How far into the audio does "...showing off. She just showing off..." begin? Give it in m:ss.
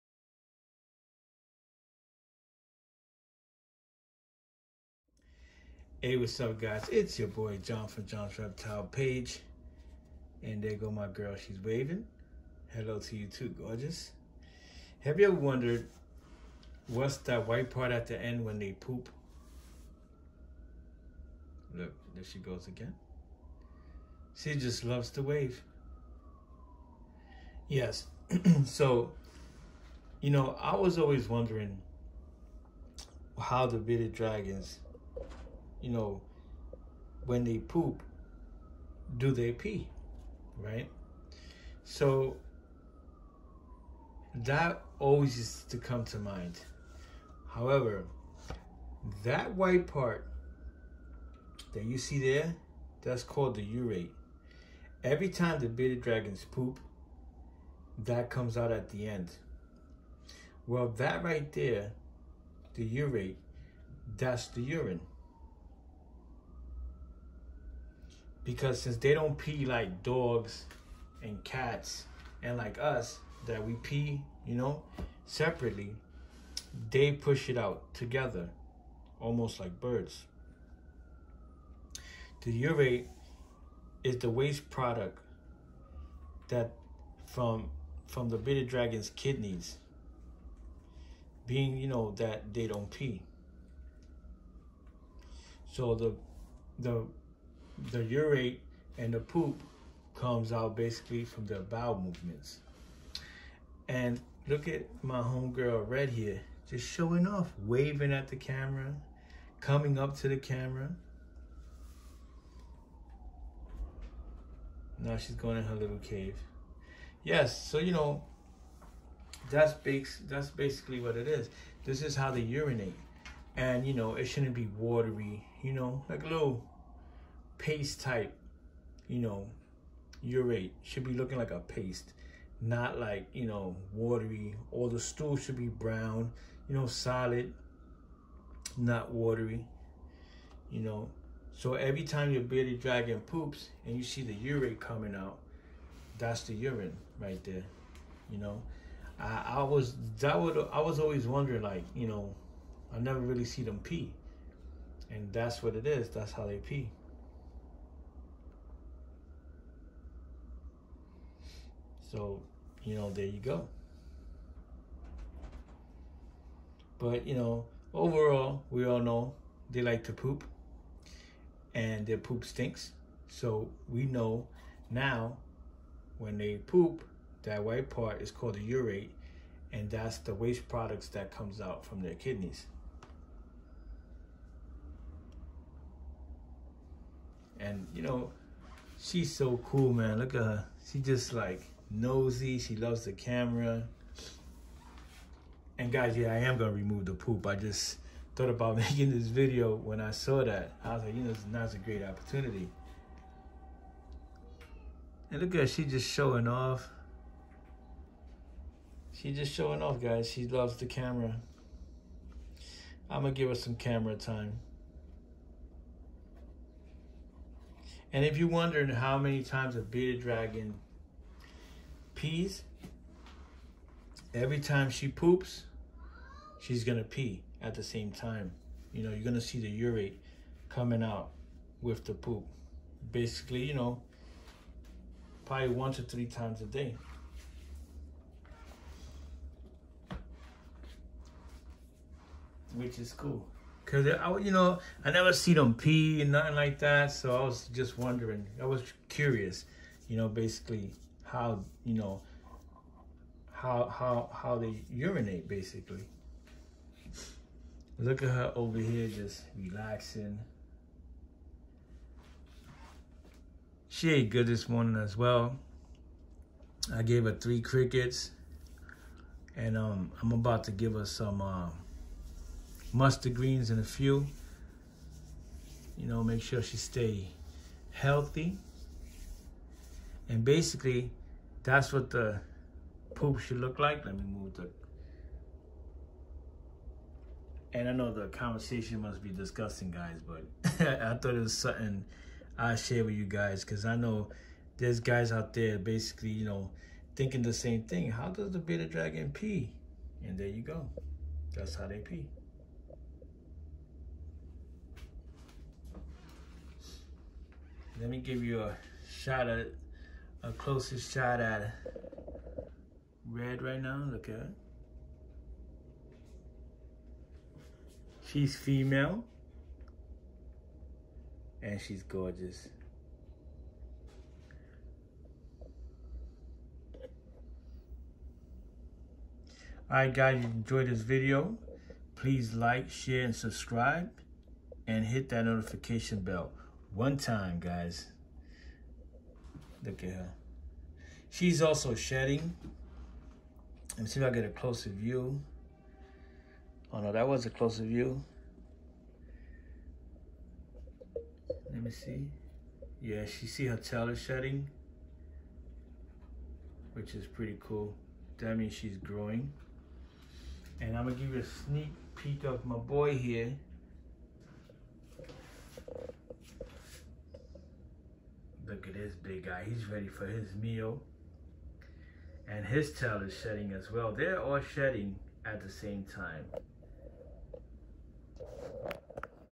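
3:26.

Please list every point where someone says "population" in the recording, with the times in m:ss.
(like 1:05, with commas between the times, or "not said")
not said.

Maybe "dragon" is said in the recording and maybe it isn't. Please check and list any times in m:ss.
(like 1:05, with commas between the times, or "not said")
0:34, 0:56, 1:28, 2:22, 3:40, 4:58.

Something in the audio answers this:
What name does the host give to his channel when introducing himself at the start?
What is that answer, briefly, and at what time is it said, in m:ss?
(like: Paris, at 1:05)
John's Reptile Page, at 0:08.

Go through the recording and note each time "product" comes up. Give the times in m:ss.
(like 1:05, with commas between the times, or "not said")
1:24, 3:00.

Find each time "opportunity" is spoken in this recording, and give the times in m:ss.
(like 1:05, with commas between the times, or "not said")
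3:22.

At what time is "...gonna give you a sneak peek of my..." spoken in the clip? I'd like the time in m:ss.
6:01.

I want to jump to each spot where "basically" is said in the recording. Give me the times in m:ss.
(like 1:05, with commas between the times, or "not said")
1:40, 2:00, 3:53, 4:10, 4:15, 4:40, 4:55.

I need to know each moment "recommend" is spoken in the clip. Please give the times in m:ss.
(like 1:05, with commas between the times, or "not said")
not said.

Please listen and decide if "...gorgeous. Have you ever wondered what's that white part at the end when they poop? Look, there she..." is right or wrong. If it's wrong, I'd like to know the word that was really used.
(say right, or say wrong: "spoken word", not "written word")
right.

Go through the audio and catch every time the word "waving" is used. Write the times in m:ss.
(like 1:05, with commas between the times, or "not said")
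0:11, 1:47.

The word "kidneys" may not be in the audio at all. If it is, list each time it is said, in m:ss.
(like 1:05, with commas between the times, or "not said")
1:29, 3:02.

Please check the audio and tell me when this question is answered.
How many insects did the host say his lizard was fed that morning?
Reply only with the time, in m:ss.
4:27.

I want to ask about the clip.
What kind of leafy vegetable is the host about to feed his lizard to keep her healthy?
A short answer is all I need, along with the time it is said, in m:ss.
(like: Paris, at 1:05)
mustard greens, at 4:32.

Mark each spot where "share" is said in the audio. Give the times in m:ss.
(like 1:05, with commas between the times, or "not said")
4:52, 5:32.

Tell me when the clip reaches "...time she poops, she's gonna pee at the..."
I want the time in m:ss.
3:44.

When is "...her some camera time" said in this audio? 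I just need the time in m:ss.
3:33.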